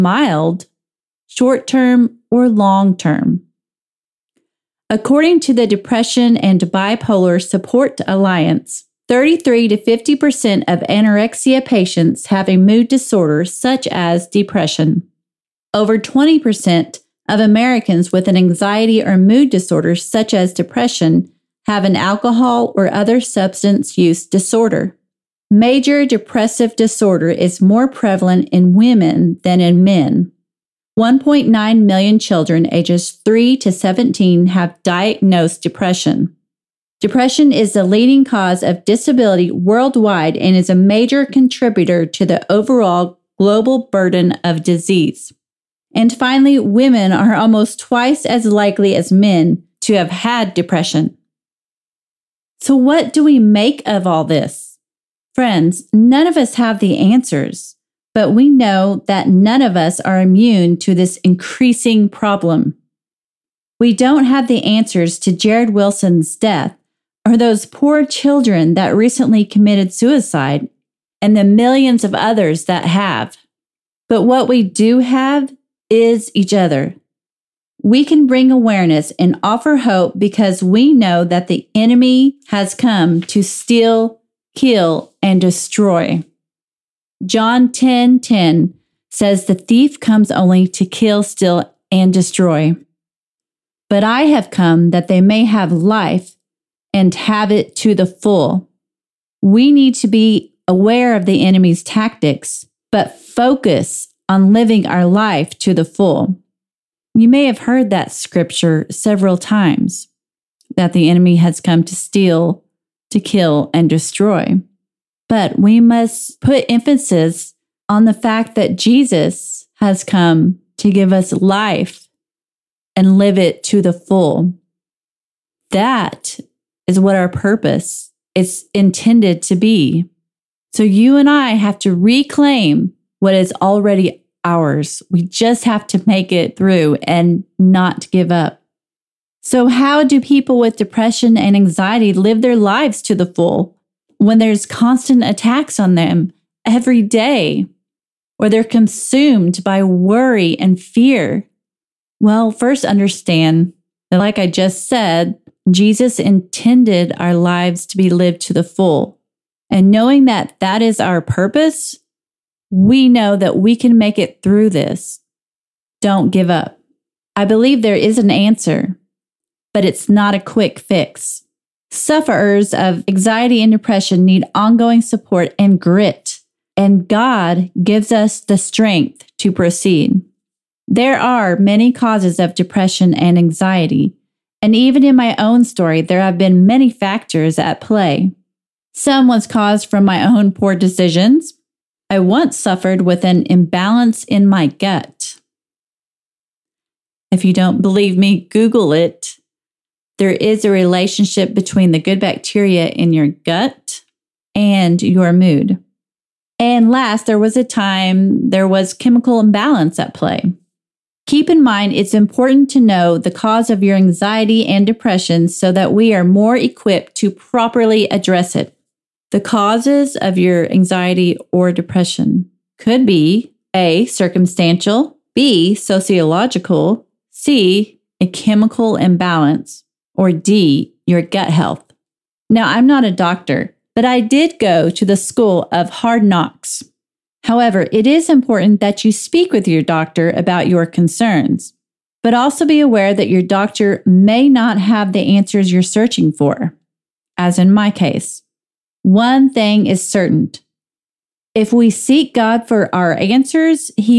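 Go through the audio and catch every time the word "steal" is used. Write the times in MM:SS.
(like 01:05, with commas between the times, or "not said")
01:23, 01:31, 01:51.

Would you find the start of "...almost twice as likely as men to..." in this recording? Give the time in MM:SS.
00:47.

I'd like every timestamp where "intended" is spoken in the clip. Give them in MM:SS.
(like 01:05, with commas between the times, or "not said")
02:08, 02:36.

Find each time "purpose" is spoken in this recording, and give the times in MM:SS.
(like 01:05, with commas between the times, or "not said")
02:07, 02:41.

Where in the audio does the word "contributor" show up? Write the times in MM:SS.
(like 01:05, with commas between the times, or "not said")
00:41.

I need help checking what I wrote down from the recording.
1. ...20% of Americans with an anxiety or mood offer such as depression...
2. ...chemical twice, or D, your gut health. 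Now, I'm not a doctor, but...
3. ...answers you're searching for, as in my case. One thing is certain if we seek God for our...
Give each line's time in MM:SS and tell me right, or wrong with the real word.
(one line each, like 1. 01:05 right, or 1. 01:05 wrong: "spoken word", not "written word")
1. 00:15 wrong: "disorder", not "offer"
2. 03:48 wrong: "imbalance", not "twice"
3. 04:05 right.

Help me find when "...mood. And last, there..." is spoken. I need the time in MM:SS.
03:25.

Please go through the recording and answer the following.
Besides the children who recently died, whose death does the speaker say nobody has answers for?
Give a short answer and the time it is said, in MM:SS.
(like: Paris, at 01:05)
Jarrid Wilson, at 01:05.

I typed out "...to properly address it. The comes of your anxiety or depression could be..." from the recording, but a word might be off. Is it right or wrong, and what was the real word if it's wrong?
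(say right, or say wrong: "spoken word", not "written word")
wrong: "causes", not "comes".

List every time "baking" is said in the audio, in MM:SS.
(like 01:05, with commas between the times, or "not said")
not said.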